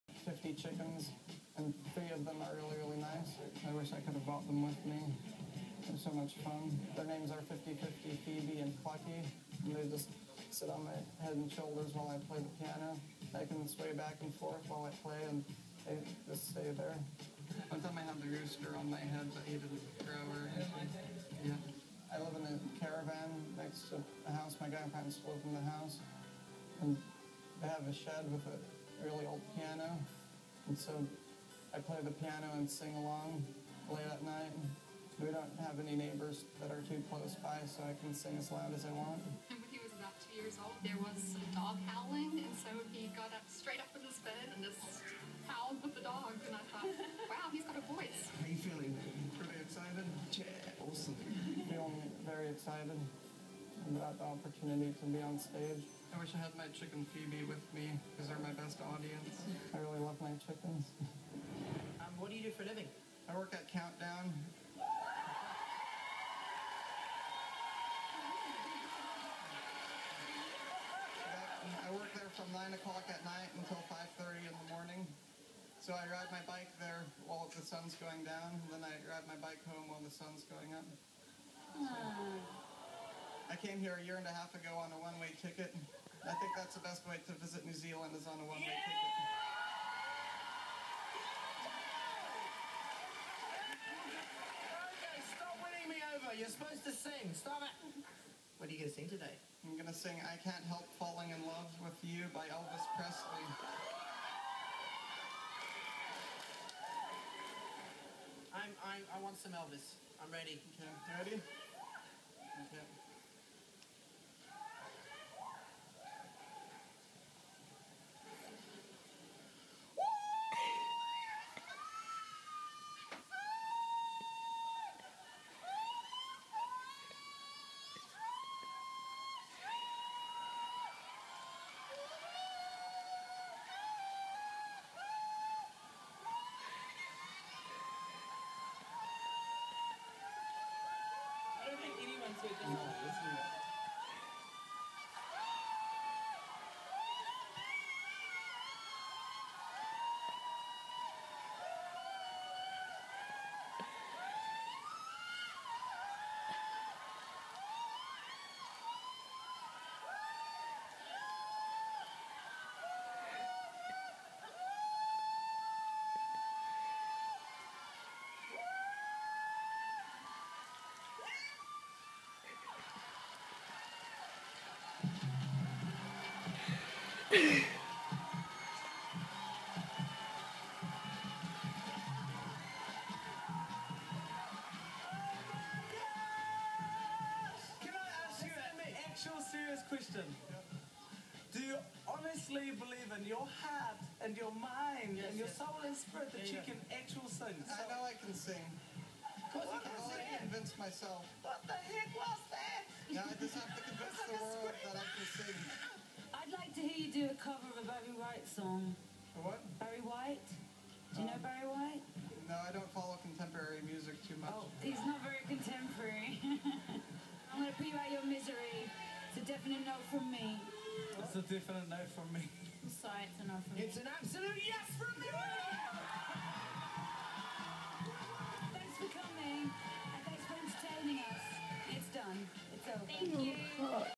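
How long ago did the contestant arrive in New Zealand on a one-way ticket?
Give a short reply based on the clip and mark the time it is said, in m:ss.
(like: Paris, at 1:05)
a year and a half, at 1:23.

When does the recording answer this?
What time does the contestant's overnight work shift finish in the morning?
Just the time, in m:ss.
1:13.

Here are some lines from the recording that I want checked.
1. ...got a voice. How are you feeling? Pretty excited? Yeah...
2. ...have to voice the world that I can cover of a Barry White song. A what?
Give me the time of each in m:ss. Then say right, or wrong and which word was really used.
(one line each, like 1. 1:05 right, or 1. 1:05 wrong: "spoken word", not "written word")
1. 0:47 right
2. 3:23 wrong: "convince", not "voice".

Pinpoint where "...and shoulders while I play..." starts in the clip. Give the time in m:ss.
0:11.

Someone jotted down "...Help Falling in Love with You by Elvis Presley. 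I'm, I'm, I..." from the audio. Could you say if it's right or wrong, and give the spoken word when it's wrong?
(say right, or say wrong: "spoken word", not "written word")
right.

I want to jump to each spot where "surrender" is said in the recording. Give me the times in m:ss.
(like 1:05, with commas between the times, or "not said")
not said.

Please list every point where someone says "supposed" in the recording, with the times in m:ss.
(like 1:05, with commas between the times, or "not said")
1:36.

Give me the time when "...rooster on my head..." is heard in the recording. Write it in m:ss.
0:18.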